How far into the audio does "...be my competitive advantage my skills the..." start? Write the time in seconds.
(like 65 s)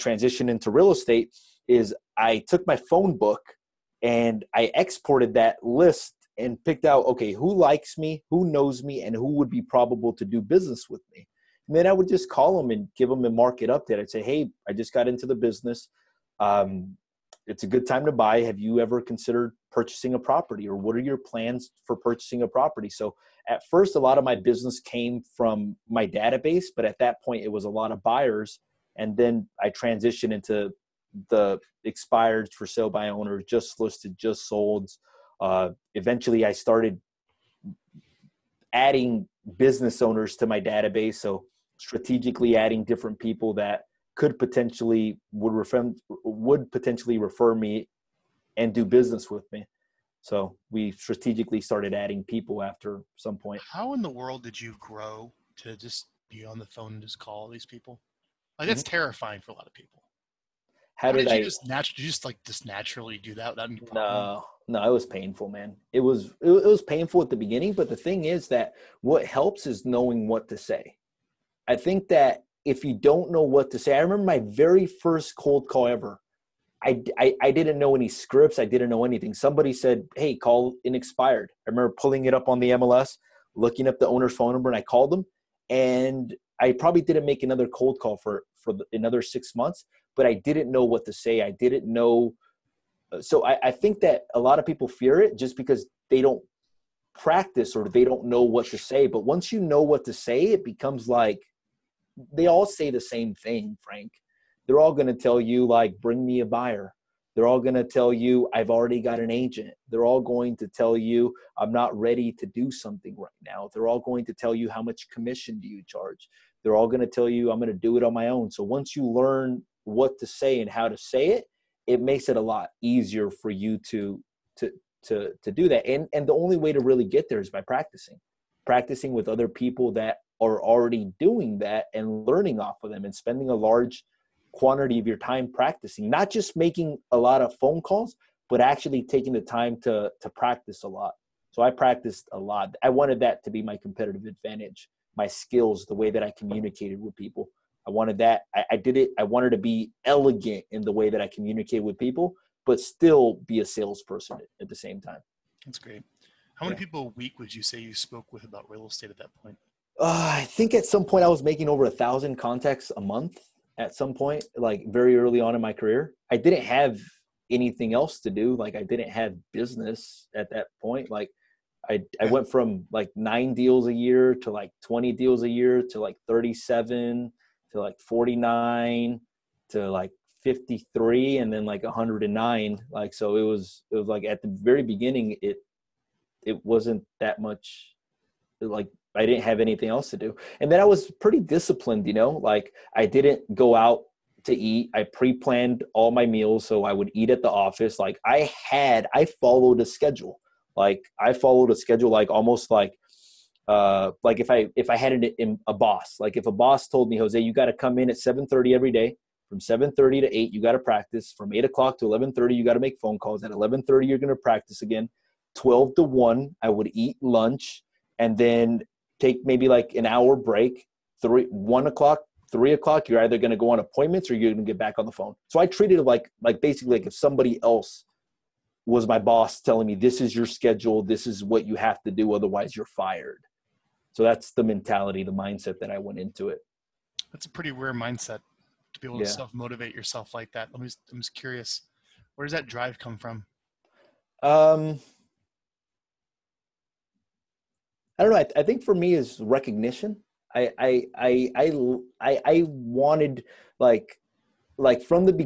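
143 s.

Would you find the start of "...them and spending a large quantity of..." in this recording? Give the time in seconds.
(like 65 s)
132 s.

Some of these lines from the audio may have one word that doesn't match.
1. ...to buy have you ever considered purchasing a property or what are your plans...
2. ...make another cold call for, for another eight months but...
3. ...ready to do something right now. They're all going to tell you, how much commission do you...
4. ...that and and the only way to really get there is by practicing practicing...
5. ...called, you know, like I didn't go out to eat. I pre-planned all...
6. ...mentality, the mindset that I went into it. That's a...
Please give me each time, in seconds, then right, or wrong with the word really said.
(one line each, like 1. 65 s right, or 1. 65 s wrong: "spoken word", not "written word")
1. 18 s right
2. 87 s wrong: "six", not "eight"
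3. 111 s right
4. 125 s right
5. 191 s wrong: "disciplined", not "called"
6. 234 s right.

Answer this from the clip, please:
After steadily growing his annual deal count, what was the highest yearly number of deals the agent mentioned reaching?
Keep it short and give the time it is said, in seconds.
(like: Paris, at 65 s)
109, at 181 s.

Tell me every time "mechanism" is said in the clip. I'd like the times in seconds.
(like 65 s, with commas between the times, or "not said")
not said.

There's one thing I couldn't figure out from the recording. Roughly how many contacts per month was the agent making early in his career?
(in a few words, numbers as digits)
over 1,000.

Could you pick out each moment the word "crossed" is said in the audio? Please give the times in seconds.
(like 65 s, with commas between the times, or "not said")
not said.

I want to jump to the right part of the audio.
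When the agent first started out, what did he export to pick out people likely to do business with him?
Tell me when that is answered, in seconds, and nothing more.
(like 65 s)
2 s.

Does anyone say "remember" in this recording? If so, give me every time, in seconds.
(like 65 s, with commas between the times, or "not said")
74 s, 81 s.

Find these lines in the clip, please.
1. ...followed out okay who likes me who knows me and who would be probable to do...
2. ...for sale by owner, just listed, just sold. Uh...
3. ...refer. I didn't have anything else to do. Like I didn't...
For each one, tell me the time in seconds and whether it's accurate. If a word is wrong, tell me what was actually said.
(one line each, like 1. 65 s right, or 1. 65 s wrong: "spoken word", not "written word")
1. 6 s wrong: "picked", not "followed"
2. 32 s right
3. 165 s wrong: "career", not "refer".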